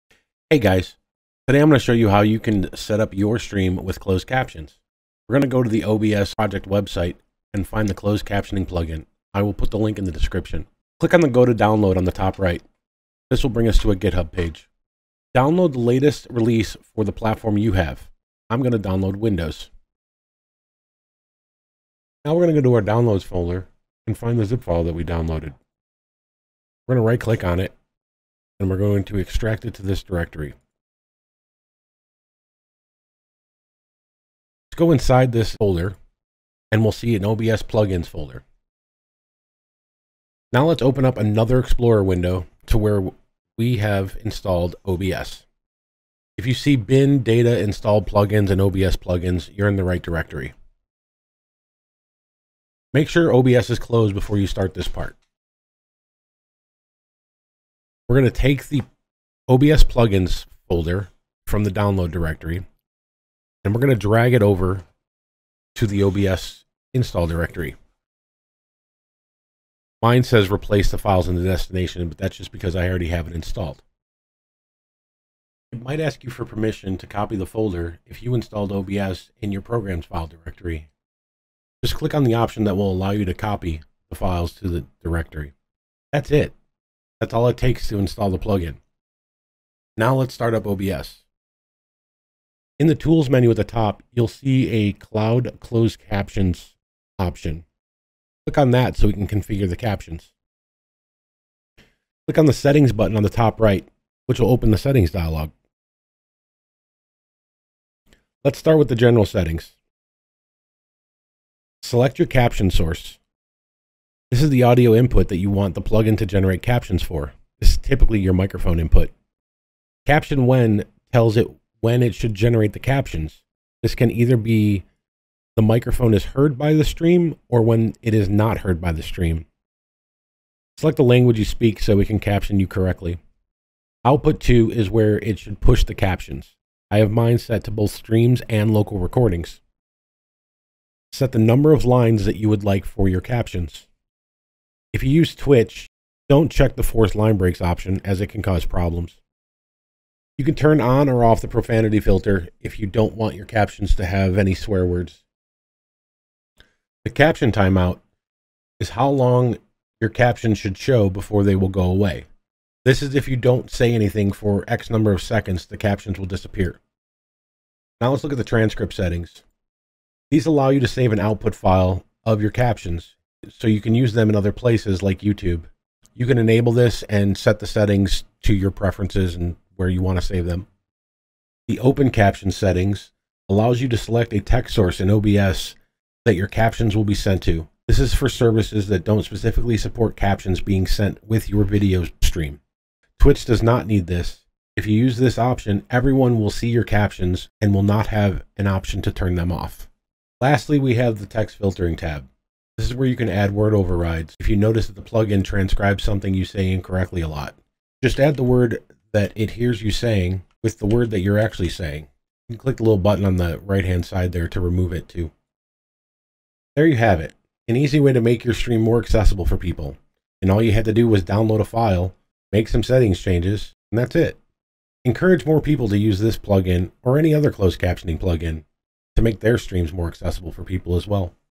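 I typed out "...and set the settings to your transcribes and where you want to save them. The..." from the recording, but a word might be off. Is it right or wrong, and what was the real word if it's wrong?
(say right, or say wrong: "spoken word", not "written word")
wrong: "preferences", not "transcribes".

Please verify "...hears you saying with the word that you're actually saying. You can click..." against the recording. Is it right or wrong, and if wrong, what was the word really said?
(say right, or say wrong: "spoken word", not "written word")
right.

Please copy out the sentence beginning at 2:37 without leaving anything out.
The caption timeout is how long your caption should show before they will go away.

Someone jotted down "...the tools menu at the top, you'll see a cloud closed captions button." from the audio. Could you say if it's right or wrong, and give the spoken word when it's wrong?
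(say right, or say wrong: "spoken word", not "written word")
wrong: "option", not "button".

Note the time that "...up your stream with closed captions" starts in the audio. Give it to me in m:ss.
0:02.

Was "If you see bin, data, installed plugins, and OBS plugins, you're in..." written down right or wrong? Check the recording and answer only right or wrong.
right.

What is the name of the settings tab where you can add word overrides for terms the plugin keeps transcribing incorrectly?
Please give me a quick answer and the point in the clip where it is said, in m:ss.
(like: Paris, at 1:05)
text filtering, at 3:21.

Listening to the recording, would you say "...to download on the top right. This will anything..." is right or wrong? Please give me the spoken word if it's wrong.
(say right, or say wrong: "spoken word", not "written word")
wrong: "bring", not "anything".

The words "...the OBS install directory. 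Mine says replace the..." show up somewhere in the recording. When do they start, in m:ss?
1:05.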